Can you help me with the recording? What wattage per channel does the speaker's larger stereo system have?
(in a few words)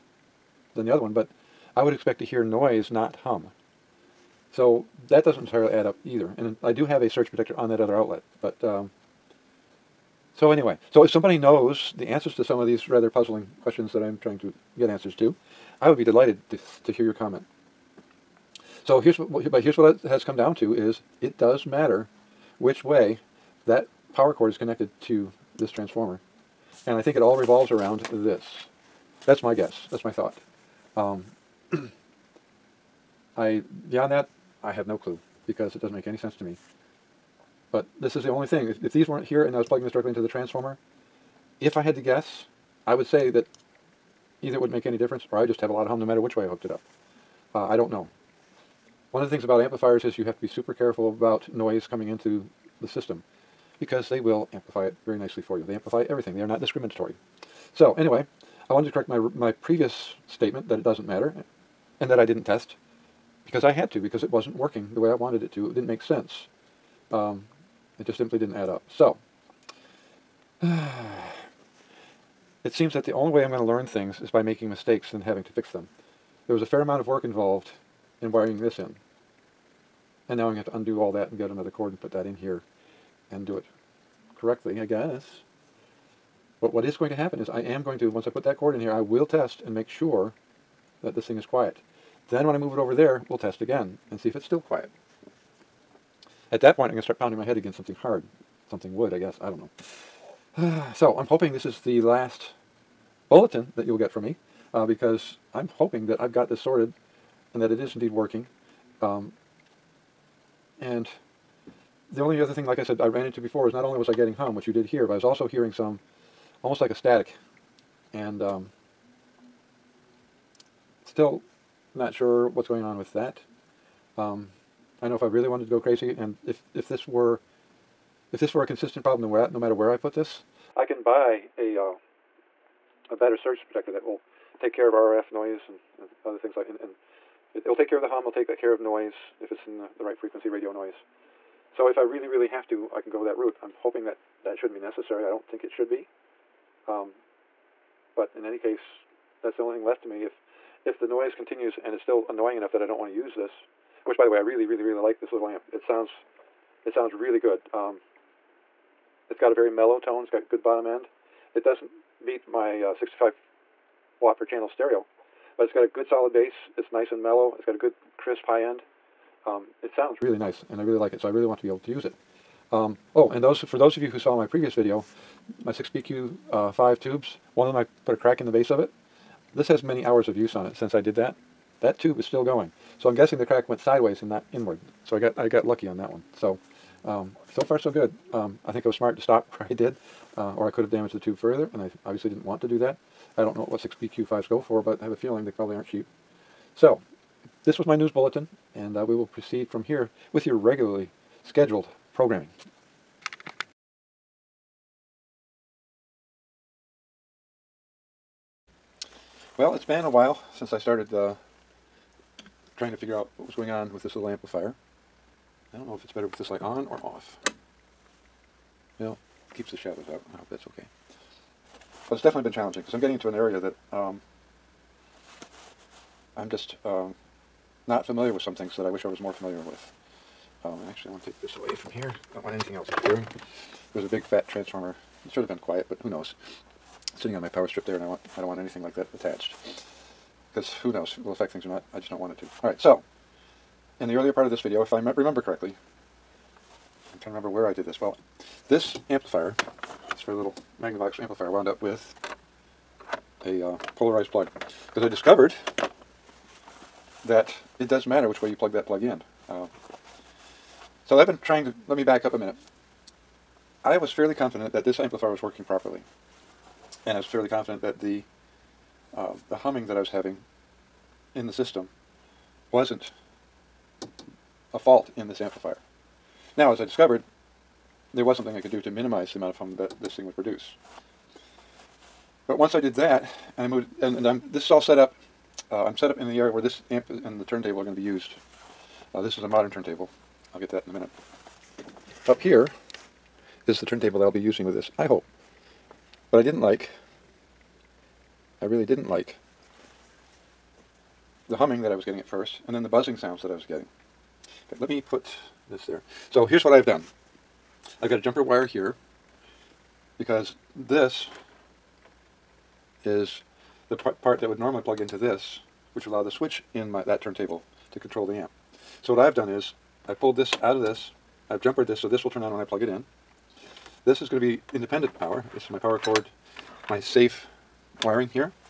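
65 watt.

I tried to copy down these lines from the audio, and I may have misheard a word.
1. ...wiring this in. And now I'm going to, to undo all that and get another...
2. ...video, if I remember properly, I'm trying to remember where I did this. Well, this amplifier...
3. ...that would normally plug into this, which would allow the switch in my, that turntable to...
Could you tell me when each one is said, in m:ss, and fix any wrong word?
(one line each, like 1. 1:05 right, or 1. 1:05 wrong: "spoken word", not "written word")
1. 1:18 right
2. 4:04 wrong: "correctly", not "properly"
3. 5:14 right.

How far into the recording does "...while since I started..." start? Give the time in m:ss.
3:30.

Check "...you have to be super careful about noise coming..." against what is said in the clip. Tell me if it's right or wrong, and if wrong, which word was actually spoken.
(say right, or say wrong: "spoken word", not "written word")
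right.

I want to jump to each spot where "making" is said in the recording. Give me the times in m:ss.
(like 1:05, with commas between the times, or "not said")
1:14.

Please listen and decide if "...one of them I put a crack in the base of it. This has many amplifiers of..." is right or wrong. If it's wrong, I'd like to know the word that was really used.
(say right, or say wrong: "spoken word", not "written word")
wrong: "hours", not "amplifiers".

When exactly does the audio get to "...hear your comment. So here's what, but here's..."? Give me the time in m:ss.
0:16.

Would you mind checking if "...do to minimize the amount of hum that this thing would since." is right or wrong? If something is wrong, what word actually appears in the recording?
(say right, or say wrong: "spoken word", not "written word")
wrong: "produce", not "since".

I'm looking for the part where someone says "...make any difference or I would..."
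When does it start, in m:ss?
0:44.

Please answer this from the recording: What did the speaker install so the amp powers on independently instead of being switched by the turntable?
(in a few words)
jumper wire.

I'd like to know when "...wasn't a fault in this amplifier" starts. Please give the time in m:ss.
4:32.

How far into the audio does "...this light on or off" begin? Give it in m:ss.
3:36.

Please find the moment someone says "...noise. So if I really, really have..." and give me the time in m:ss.
2:20.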